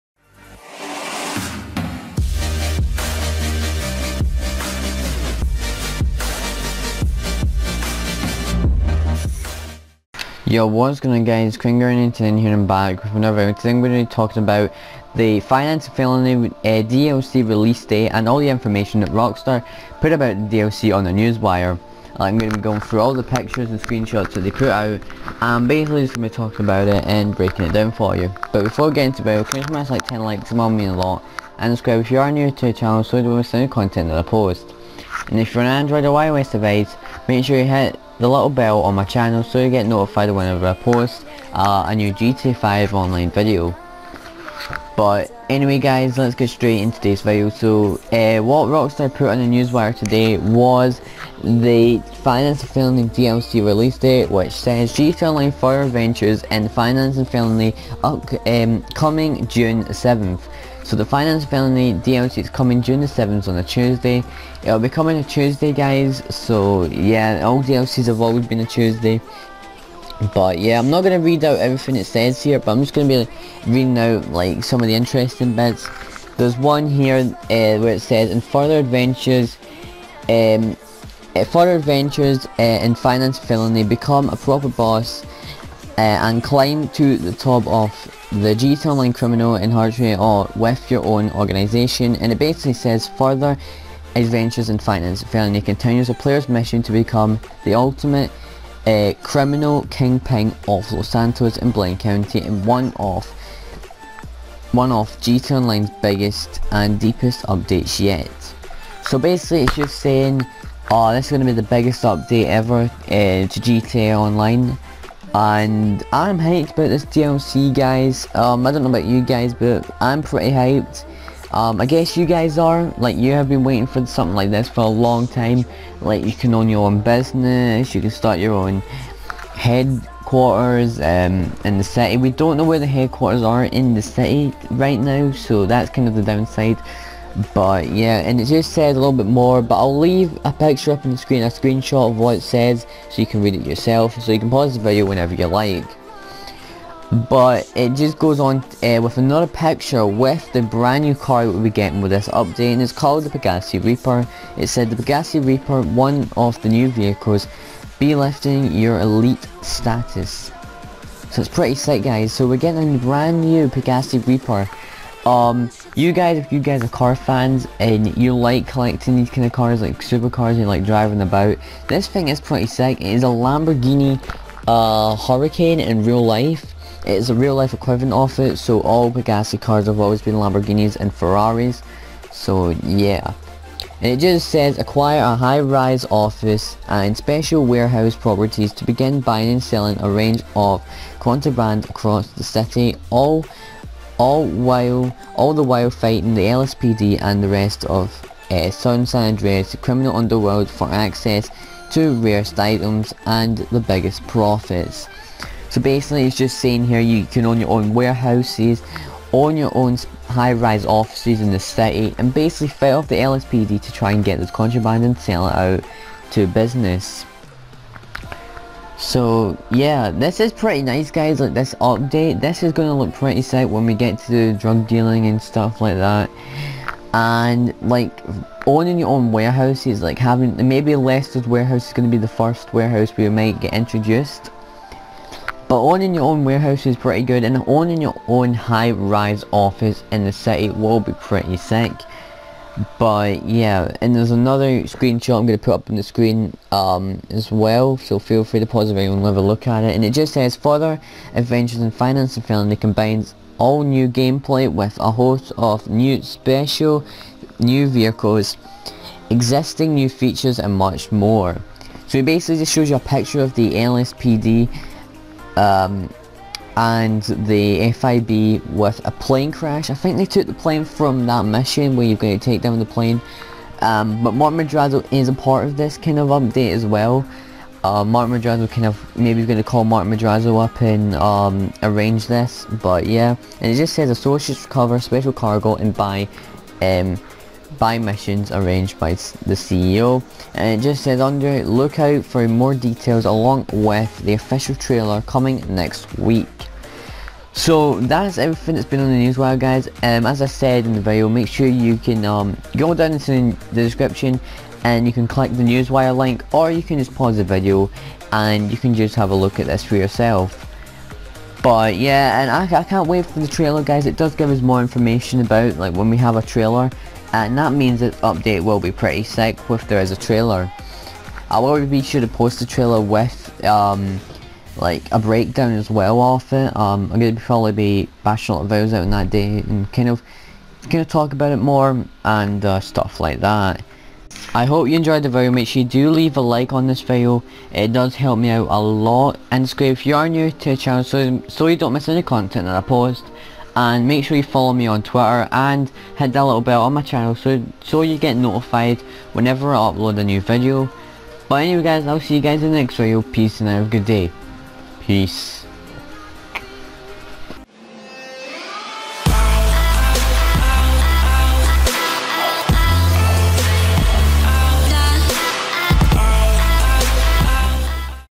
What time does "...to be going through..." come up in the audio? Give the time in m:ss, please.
0:22.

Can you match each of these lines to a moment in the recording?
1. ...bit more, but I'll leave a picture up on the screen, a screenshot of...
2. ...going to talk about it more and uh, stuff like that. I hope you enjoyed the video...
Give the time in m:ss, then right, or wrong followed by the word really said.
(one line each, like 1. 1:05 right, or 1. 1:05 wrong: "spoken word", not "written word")
1. 2:19 right
2. 5:30 right.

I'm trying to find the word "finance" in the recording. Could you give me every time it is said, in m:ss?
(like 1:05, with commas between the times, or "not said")
0:15, 0:52, 0:56, 1:01, 1:22, 1:34, 4:11.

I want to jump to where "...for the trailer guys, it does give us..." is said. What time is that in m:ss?
5:13.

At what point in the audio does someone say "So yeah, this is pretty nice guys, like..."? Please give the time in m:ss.
3:38.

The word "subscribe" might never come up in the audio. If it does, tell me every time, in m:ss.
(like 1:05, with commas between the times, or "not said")
0:31, 5:39.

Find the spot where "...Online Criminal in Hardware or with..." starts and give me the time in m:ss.
1:28.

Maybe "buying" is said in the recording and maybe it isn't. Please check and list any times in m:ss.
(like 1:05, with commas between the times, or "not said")
3:09.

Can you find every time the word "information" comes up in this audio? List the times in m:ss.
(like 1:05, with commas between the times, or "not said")
0:18, 5:14.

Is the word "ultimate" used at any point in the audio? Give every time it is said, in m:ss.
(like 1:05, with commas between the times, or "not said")
1:37.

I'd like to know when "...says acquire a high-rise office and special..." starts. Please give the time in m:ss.
3:04.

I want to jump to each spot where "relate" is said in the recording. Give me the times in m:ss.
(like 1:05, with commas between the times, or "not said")
not said.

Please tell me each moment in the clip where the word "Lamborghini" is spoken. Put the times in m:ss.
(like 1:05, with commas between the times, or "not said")
2:53, 3:00.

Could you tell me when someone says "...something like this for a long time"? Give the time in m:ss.
2:04.